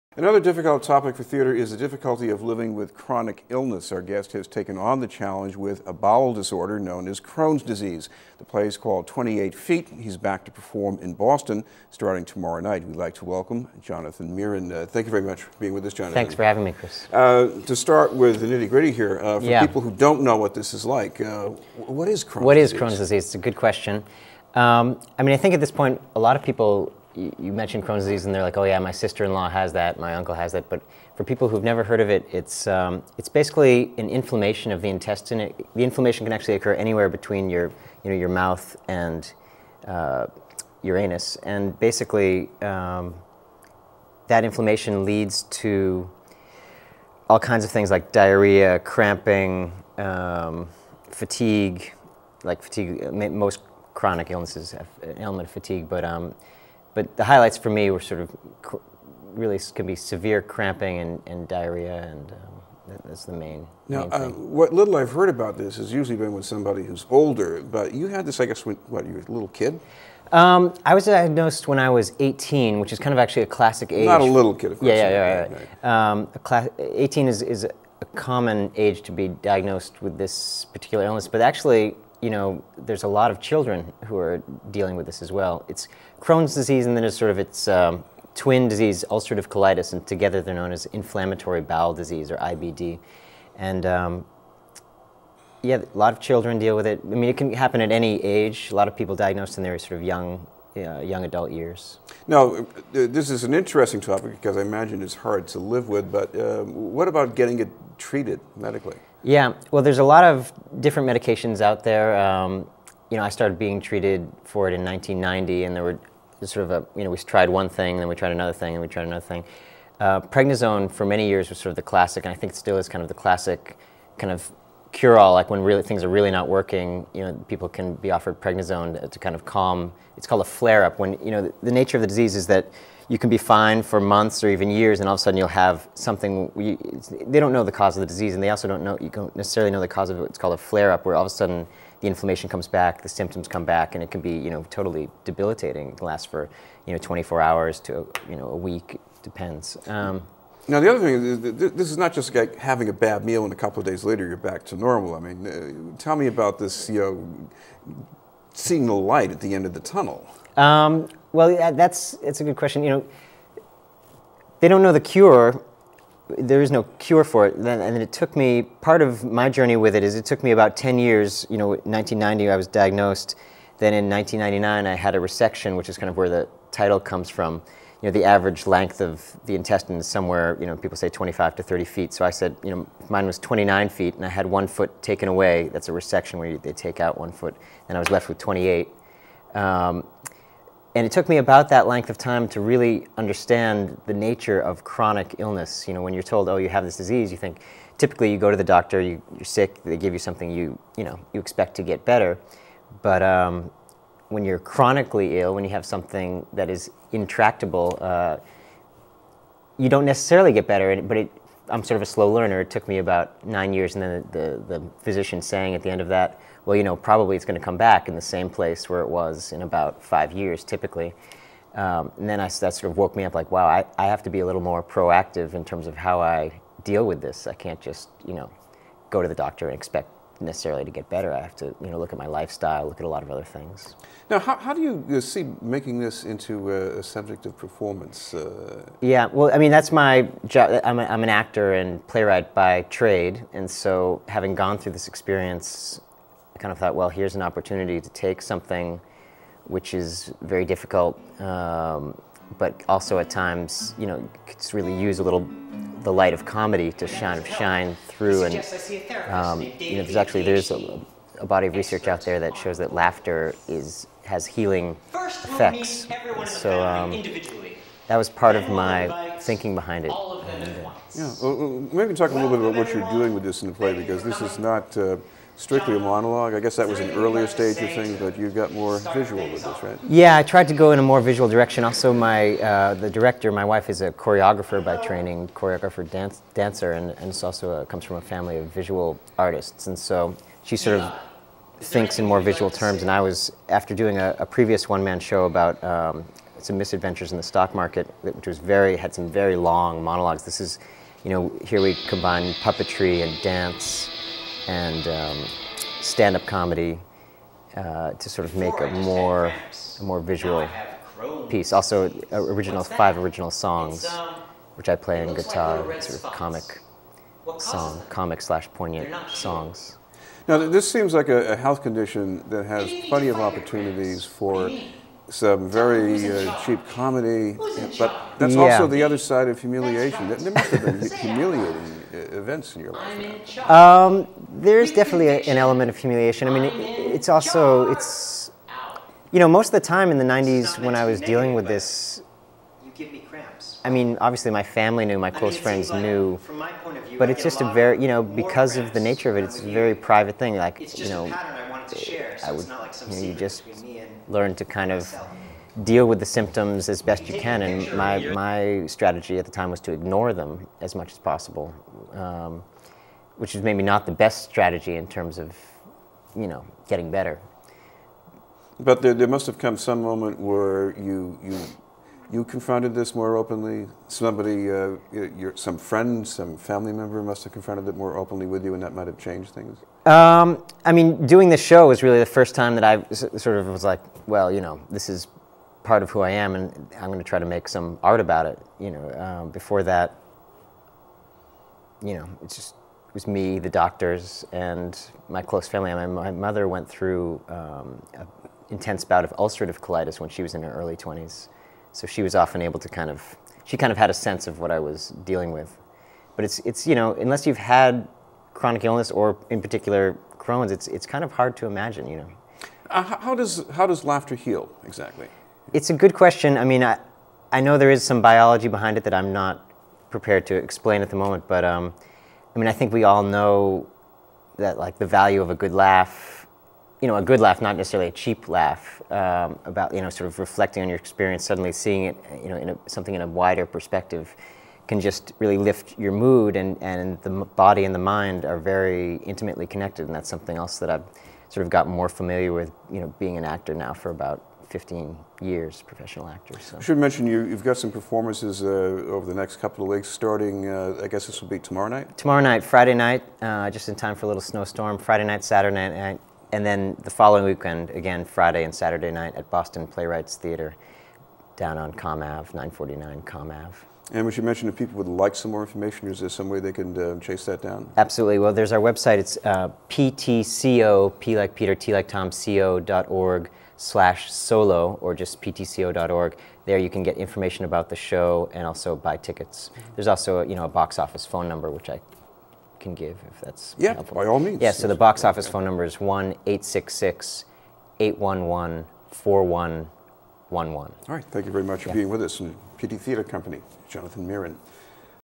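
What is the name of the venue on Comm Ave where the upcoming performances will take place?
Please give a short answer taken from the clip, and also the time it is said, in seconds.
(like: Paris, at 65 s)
Boston Playwrights Theater, at 459 s.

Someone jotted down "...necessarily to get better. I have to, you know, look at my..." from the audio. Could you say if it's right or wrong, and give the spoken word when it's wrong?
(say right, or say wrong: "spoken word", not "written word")
right.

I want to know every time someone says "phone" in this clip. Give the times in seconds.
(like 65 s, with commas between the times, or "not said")
481 s, 485 s.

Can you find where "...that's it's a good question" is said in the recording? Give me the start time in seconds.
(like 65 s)
161 s.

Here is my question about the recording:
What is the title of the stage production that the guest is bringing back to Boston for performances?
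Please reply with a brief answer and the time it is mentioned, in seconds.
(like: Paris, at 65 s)
28 Feet, at 9 s.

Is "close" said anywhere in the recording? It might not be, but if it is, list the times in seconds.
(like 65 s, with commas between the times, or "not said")
345 s, 395 s.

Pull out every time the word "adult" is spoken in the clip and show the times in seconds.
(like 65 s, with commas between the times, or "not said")
101 s.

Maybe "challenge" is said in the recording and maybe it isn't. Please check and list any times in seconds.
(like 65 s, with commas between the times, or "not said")
5 s.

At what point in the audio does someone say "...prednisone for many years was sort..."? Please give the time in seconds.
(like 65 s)
120 s.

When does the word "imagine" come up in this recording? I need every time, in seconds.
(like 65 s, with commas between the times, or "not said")
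104 s, 411 s.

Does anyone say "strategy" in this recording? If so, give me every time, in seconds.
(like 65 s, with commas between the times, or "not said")
358 s, 364 s.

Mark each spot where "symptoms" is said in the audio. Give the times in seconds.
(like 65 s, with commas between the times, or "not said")
143 s, 356 s.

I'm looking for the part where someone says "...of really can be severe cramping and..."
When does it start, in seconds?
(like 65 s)
58 s.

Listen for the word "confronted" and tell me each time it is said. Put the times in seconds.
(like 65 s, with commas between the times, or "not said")
372 s, 377 s.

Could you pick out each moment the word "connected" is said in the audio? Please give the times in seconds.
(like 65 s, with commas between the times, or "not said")
439 s.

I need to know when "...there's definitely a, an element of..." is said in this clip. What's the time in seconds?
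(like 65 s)
334 s.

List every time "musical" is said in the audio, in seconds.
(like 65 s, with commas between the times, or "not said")
not said.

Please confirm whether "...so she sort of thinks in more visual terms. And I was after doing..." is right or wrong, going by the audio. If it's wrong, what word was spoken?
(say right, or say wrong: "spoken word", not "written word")
right.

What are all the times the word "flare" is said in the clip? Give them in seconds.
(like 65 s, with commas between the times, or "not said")
130 s, 140 s.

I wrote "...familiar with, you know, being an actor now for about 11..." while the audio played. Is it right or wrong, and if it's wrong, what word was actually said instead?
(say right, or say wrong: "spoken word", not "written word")
wrong: "15", not "11".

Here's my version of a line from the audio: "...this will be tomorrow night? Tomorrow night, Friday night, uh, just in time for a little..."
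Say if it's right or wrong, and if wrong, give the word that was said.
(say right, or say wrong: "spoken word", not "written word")
right.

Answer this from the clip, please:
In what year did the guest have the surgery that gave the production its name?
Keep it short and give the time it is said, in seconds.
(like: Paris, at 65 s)
1999, at 174 s.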